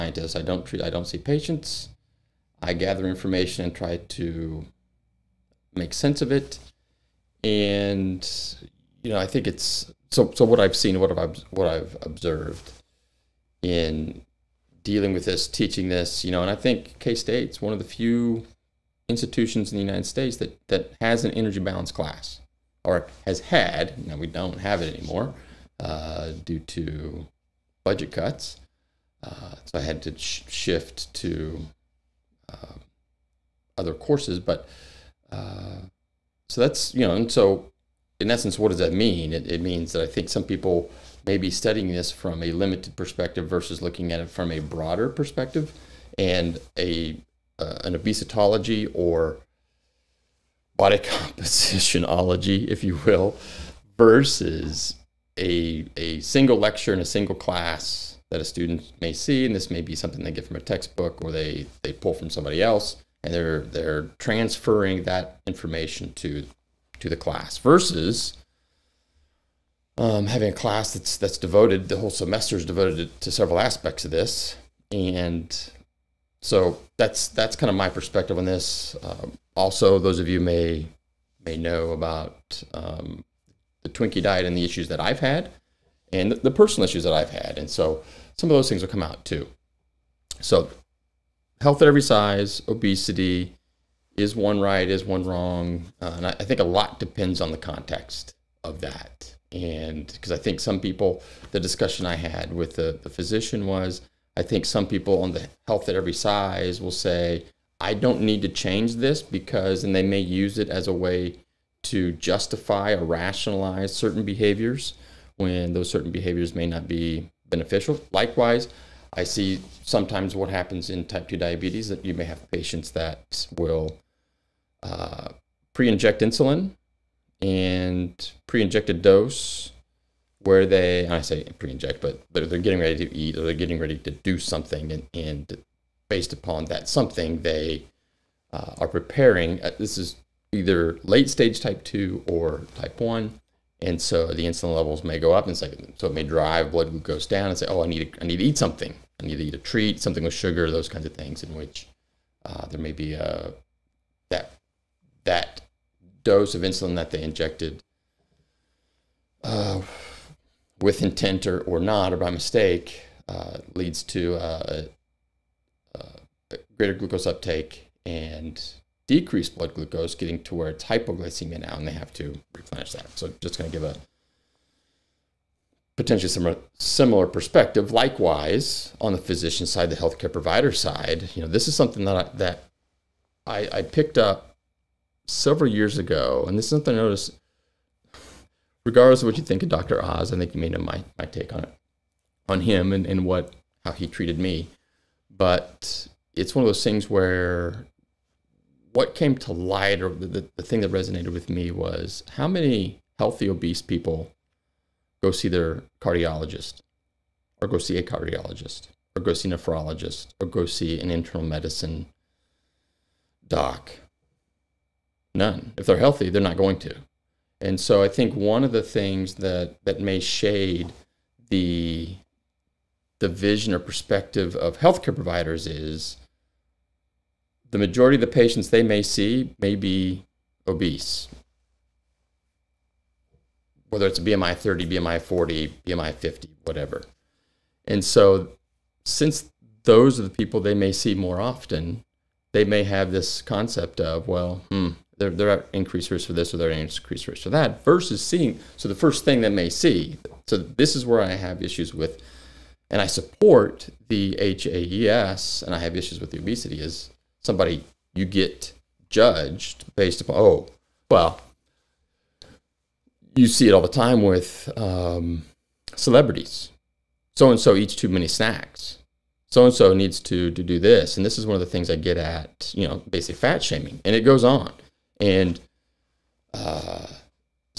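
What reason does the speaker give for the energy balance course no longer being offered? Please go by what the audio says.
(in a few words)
budget cuts.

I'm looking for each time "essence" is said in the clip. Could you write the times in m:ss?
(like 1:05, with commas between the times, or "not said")
0:38.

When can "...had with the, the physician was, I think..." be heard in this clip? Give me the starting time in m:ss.
1:42.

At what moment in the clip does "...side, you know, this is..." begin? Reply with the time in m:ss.
3:00.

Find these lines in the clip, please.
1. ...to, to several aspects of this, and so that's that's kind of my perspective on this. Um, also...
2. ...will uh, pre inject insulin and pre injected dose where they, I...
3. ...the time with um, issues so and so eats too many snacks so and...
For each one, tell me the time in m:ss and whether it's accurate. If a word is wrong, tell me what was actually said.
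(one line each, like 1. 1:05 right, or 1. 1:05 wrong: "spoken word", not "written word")
1. 1:13 right
2. 2:03 right
3. 4:23 wrong: "celebrities", not "issues".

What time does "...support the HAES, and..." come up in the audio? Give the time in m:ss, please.
4:13.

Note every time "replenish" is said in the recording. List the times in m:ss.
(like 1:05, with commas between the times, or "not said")
2:52.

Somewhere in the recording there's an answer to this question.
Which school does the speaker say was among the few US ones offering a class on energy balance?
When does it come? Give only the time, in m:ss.
0:16.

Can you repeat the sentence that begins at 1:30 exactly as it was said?
So, health at every size, obesity, is one right, is one wrong?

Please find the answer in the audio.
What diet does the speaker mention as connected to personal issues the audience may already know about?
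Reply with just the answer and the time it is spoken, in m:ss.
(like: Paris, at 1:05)
the Twinkie diet, at 1:23.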